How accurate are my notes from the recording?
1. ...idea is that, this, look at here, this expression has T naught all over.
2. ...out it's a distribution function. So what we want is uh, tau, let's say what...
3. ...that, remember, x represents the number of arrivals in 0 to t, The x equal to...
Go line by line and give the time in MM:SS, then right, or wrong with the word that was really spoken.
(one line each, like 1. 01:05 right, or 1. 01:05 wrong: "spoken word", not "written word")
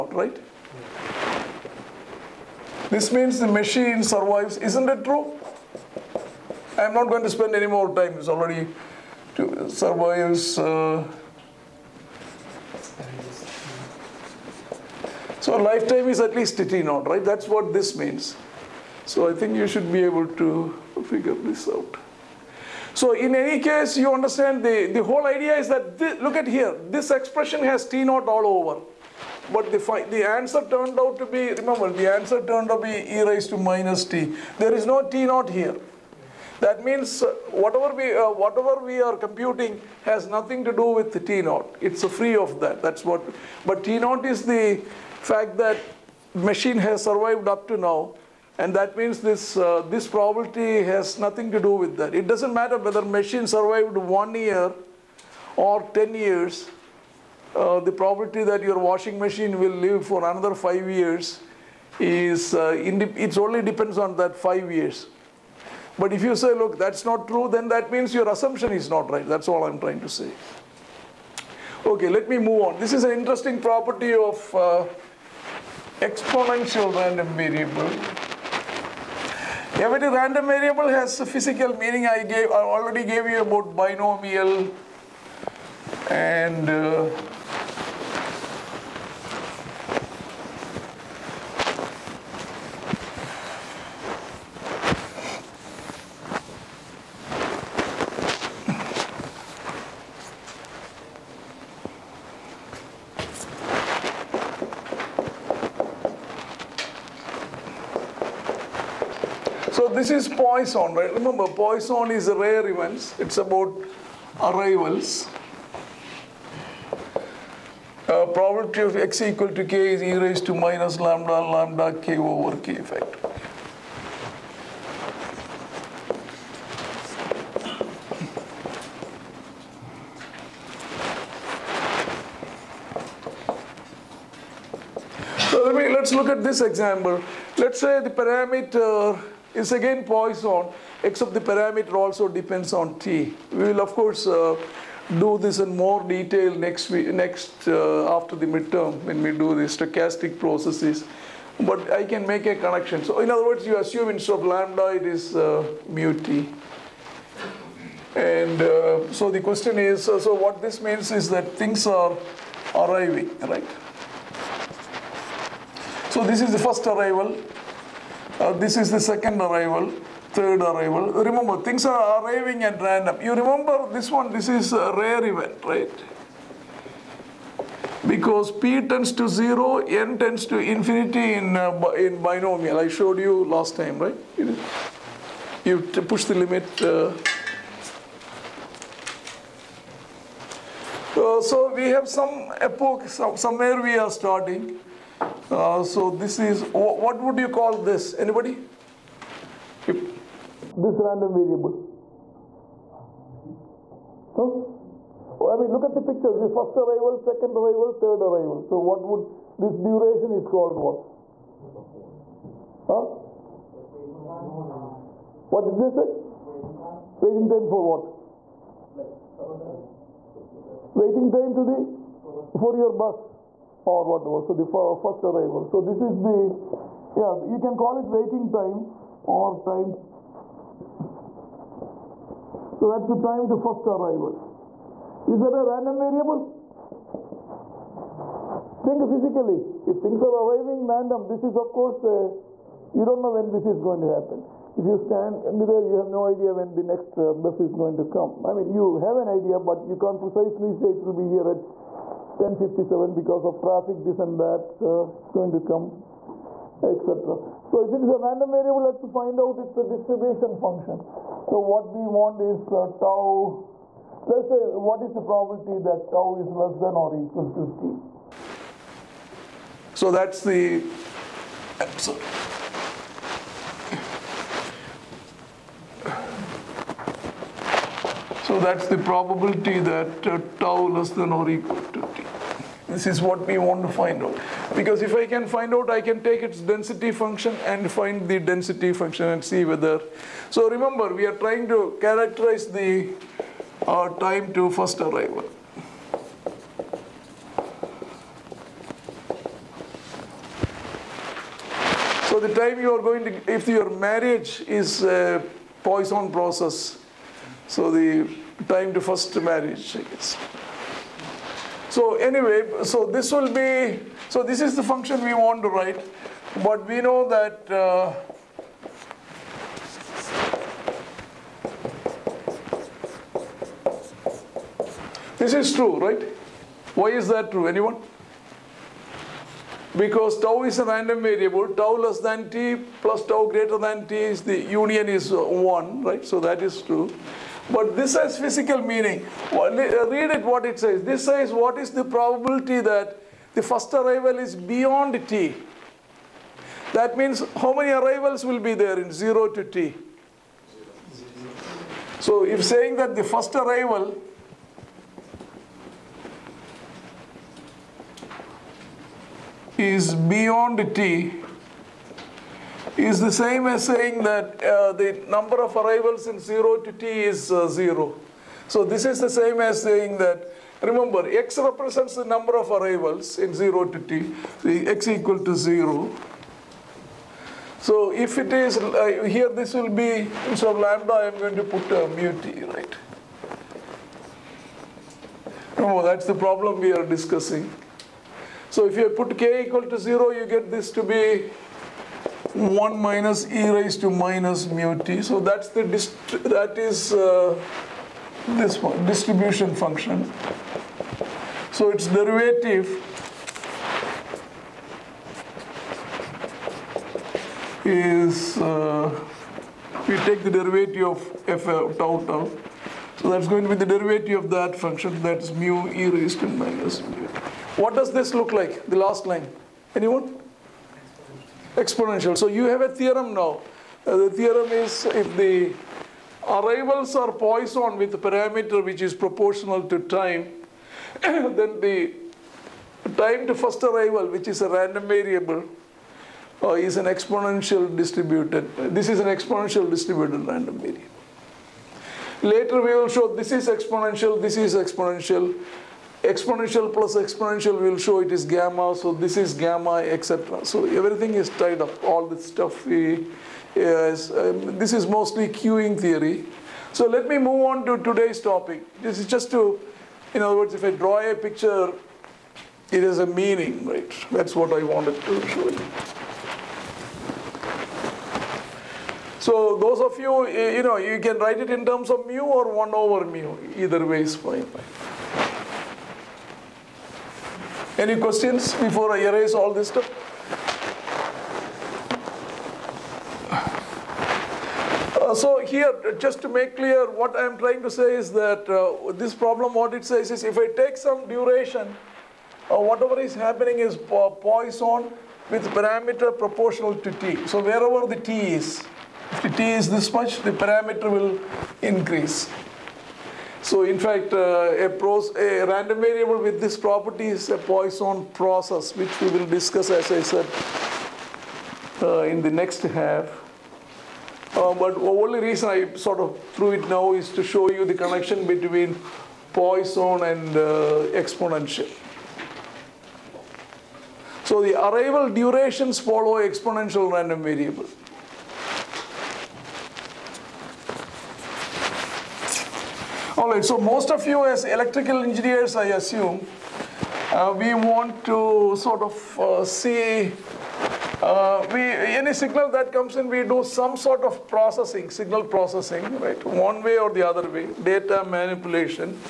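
1. 00:25 right
2. 04:19 right
3. 06:10 right.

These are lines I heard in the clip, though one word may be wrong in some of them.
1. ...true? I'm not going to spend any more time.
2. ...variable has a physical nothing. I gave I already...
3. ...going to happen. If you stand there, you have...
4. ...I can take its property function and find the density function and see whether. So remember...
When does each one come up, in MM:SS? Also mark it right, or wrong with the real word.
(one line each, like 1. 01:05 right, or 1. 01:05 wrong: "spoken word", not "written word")
1. 00:05 right
2. 01:20 wrong: "meaning", not "nothing"
3. 04:03 right
4. 04:45 wrong: "density", not "property".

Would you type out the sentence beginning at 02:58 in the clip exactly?
Because P tends to 0, N tends to infinity in, uh, in binomial.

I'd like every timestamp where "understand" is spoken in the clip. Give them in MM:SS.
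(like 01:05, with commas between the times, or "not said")
00:24.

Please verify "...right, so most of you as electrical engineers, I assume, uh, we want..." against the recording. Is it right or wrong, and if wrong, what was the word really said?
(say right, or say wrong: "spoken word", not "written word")
right.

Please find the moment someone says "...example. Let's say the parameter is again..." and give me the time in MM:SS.
02:16.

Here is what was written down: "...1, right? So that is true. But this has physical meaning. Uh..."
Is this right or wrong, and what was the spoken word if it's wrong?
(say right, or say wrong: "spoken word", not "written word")
right.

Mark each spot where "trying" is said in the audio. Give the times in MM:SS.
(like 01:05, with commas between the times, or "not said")
01:09, 04:51, 08:07.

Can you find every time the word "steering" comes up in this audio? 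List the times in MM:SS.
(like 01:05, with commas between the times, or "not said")
not said.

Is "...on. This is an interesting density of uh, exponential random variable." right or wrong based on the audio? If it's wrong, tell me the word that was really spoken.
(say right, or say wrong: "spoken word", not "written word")
wrong: "property", not "density".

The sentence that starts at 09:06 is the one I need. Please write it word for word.
One way or the other way, data manipulation.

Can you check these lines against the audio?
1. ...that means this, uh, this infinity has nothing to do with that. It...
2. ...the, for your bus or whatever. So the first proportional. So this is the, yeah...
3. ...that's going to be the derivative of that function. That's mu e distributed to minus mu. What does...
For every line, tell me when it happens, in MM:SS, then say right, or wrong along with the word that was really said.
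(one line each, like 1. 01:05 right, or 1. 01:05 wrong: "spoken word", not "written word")
1. 00:48 wrong: "probability", not "infinity"
2. 03:41 wrong: "arrival", not "proportional"
3. 06:53 wrong: "raised", not "distributed".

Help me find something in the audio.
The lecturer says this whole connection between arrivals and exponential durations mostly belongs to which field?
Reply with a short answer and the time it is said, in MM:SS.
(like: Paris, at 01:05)
queuing theory, at 07:35.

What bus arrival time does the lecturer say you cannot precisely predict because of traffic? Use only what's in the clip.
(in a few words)
1057.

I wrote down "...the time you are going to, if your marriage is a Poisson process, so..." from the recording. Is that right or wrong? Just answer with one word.
right.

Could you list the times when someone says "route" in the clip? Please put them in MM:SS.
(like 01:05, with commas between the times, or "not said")
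not said.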